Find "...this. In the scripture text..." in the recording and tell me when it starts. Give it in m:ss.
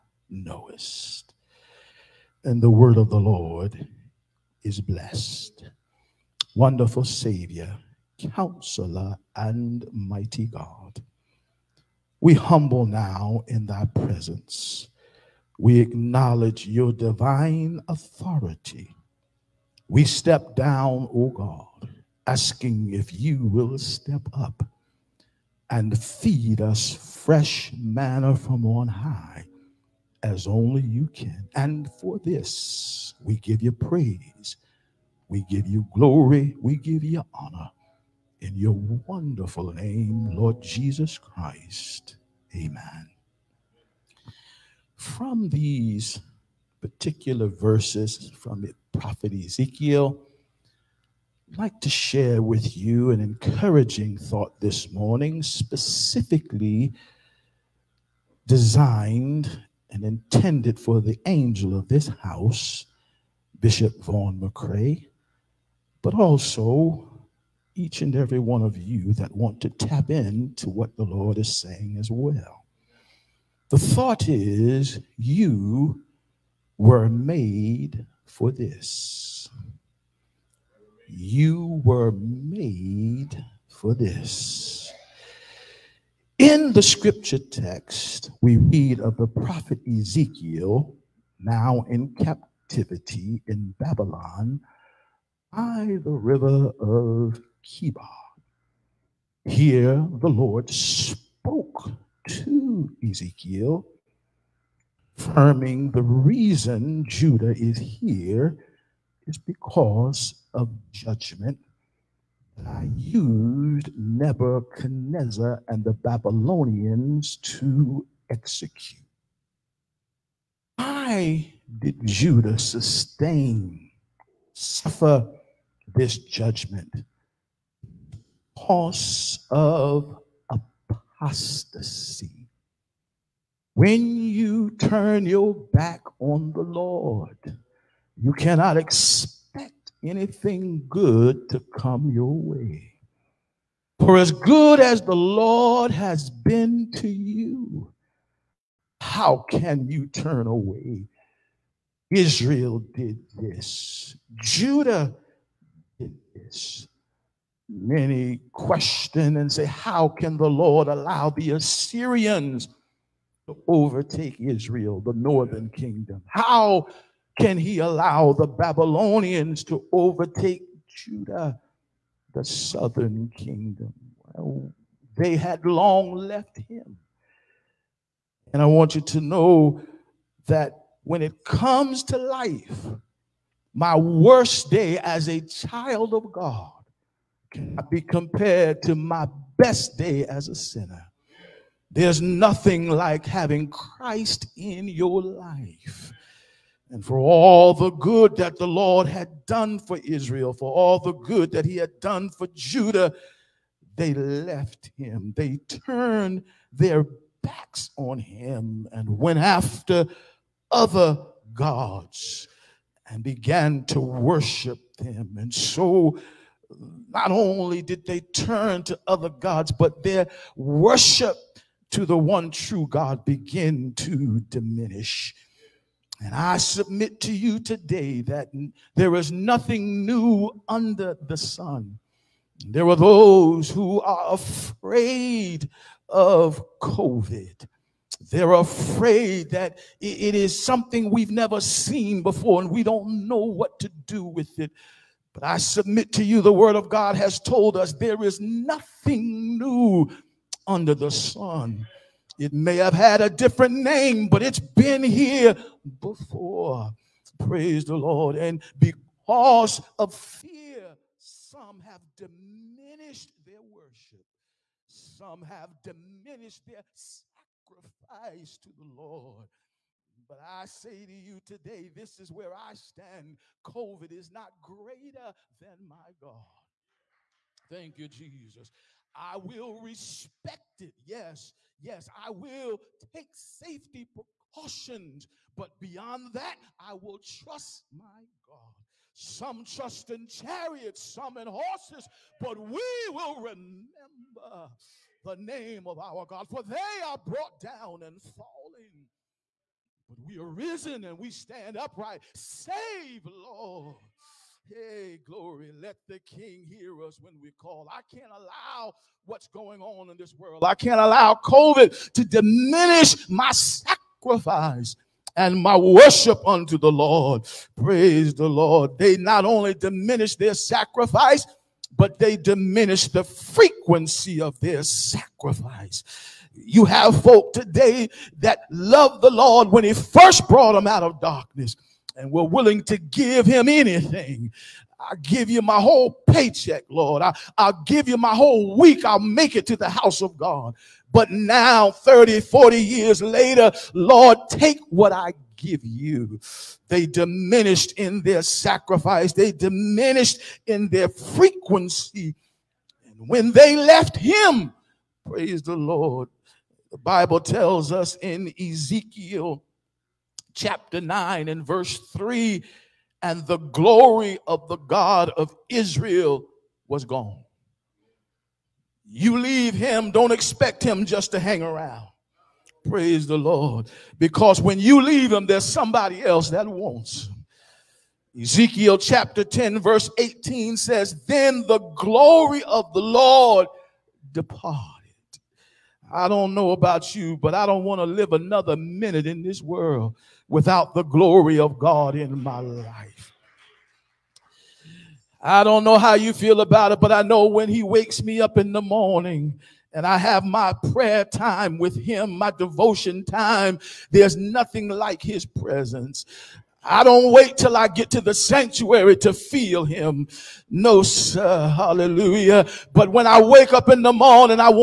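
1:23.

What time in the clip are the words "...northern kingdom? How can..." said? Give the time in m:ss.
2:45.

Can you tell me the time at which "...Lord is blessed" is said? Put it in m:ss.
0:03.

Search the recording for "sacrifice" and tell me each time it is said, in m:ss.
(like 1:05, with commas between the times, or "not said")
4:26, 5:13, 5:20, 5:24, 5:48.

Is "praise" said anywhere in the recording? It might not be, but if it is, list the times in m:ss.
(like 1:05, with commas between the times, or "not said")
0:33, 4:17, 5:17, 5:55, 6:12.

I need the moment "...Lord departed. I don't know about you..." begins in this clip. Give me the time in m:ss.
6:22.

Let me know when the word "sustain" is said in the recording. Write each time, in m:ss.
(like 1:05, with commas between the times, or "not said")
2:02.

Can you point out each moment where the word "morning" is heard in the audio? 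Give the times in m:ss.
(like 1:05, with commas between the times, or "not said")
0:54, 6:38, 6:54.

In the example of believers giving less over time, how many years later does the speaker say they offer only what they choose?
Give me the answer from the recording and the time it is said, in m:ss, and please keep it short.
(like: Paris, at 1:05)
30 to 40, at 5:41.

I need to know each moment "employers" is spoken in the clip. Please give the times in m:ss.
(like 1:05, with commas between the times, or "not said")
not said.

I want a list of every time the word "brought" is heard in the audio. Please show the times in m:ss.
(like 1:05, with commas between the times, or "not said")
4:57, 5:30.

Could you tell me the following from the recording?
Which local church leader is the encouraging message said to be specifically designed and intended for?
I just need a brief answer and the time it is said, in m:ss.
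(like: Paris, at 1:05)
Bishop Vaughn McRae, at 1:03.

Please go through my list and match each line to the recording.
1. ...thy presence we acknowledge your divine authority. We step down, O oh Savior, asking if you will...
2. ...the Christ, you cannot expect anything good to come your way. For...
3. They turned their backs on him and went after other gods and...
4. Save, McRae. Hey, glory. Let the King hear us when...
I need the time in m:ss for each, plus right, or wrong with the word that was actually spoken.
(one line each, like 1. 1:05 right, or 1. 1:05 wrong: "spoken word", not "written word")
1. 0:13 wrong: "God", not "Savior"
2. 2:16 wrong: "Lord", not "Christ"
3. 3:25 right
4. 5:02 wrong: "Lord", not "McRae".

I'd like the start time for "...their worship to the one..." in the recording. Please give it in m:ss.
3:40.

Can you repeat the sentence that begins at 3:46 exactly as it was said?
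And I submit to you today that there is nothing new under the sun.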